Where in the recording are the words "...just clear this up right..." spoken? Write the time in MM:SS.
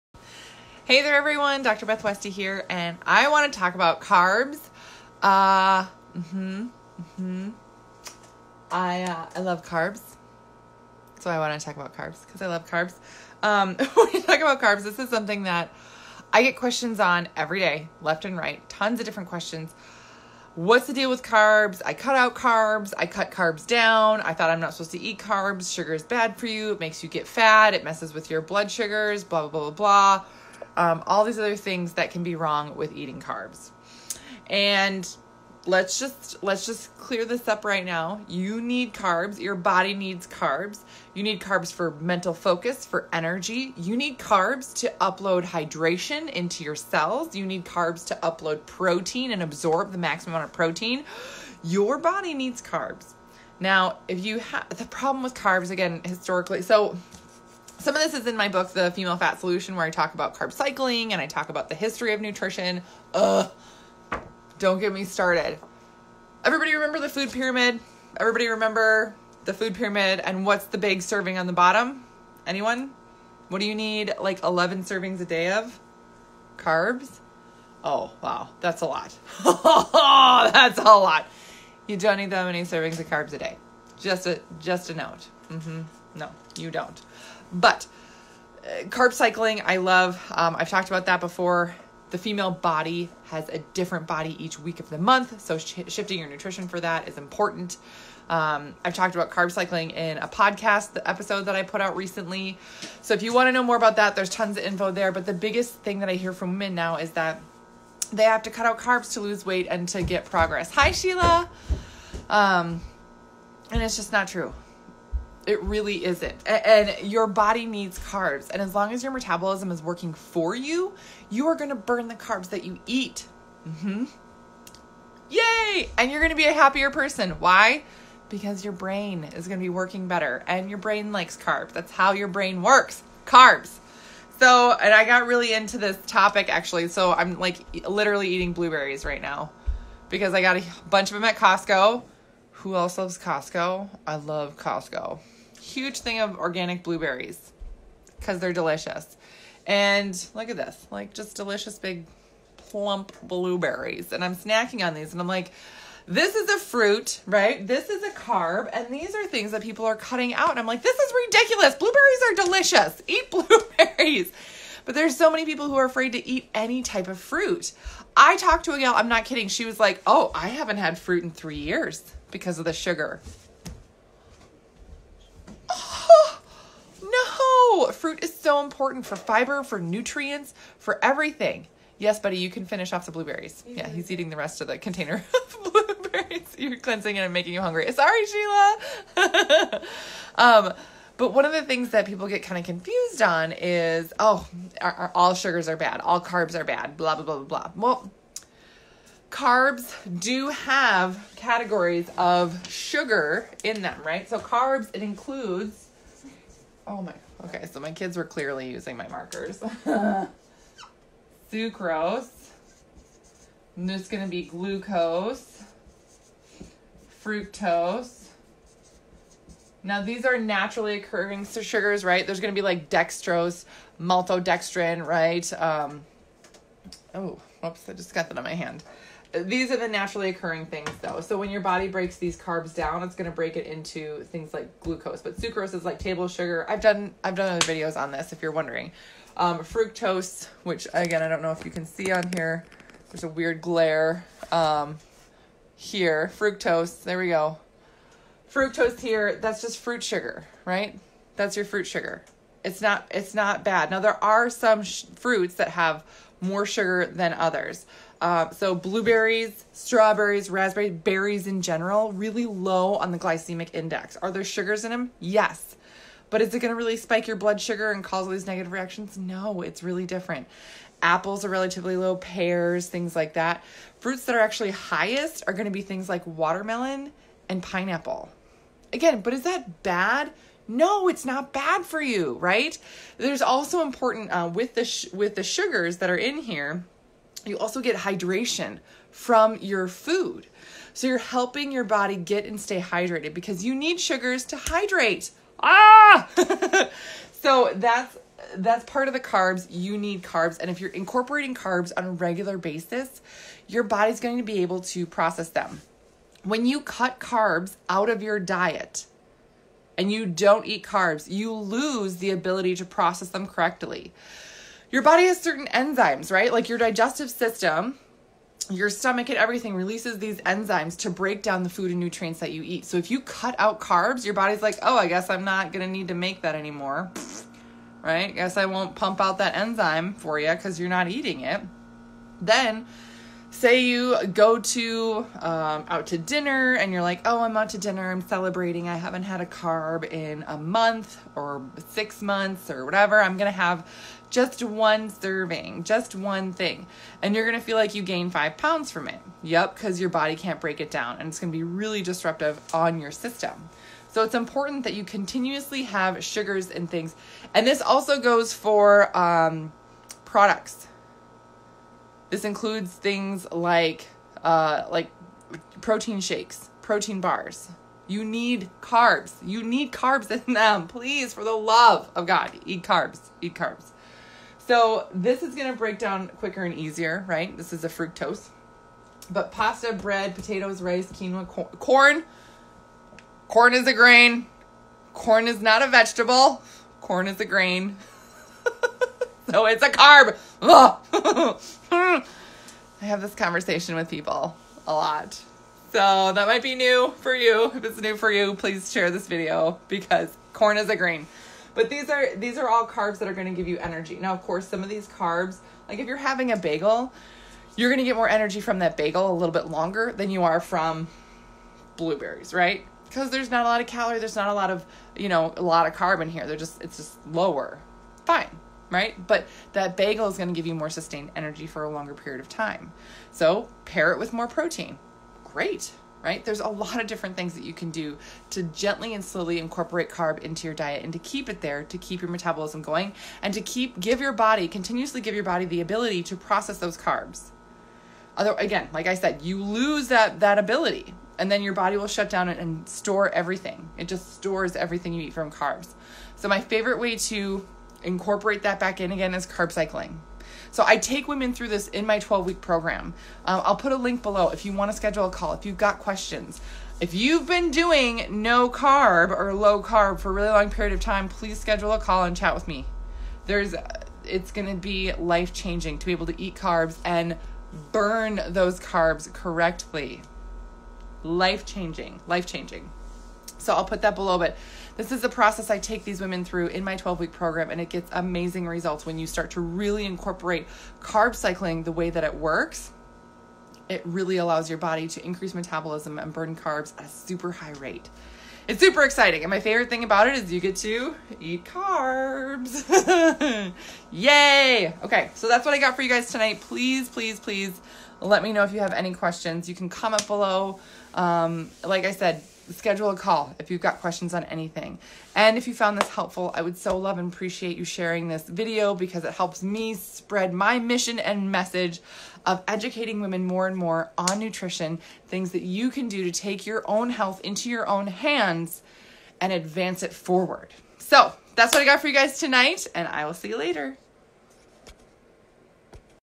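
00:36.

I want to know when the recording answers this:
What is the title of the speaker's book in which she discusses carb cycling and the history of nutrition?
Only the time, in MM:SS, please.
00:58.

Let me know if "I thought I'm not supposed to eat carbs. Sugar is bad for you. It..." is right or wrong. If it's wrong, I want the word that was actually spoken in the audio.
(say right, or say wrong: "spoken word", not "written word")
right.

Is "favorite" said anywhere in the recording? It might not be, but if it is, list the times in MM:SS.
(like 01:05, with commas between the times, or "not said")
07:26, 08:09.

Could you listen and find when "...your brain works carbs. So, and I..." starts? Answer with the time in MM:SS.
02:12.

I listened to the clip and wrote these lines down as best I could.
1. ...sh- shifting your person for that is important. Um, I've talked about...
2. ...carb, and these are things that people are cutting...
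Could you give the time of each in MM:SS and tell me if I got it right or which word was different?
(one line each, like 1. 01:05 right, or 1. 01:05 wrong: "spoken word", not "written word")
1. 01:35 wrong: "nutrition", not "person"
2. 02:38 right.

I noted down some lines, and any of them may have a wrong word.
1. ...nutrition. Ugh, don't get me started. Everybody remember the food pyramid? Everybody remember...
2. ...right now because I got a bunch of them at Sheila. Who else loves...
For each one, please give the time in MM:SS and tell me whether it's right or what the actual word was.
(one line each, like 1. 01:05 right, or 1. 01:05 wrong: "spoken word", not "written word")
1. 01:02 right
2. 02:19 wrong: "Costco", not "Sheila".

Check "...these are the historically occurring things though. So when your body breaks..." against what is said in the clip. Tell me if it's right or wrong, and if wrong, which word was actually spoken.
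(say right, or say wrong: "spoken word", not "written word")
wrong: "naturally", not "historically".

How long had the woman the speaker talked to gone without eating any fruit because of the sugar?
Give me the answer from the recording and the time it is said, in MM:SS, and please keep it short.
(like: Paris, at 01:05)
3 years, at 02:51.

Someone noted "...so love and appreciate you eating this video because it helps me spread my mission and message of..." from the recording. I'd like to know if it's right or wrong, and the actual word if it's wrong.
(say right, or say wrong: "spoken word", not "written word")
wrong: "sharing", not "eating".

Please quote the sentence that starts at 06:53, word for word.
Because there's not a lot of calorie, there's not a lot of, you know, a lot of carb in here.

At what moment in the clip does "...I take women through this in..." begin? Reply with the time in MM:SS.
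07:30.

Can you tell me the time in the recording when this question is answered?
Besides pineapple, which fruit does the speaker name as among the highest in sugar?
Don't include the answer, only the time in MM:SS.
04:36.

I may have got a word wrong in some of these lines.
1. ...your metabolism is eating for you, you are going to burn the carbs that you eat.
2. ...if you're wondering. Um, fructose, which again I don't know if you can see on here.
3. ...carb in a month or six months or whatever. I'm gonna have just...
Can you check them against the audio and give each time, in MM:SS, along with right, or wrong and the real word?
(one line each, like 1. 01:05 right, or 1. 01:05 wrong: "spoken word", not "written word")
1. 01:59 wrong: "working", not "eating"
2. 03:58 right
3. 05:39 right.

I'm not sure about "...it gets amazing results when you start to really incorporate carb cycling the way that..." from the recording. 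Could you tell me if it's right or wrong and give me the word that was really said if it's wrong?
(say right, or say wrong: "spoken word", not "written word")
right.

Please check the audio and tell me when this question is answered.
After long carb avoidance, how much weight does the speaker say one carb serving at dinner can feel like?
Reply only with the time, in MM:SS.
05:48.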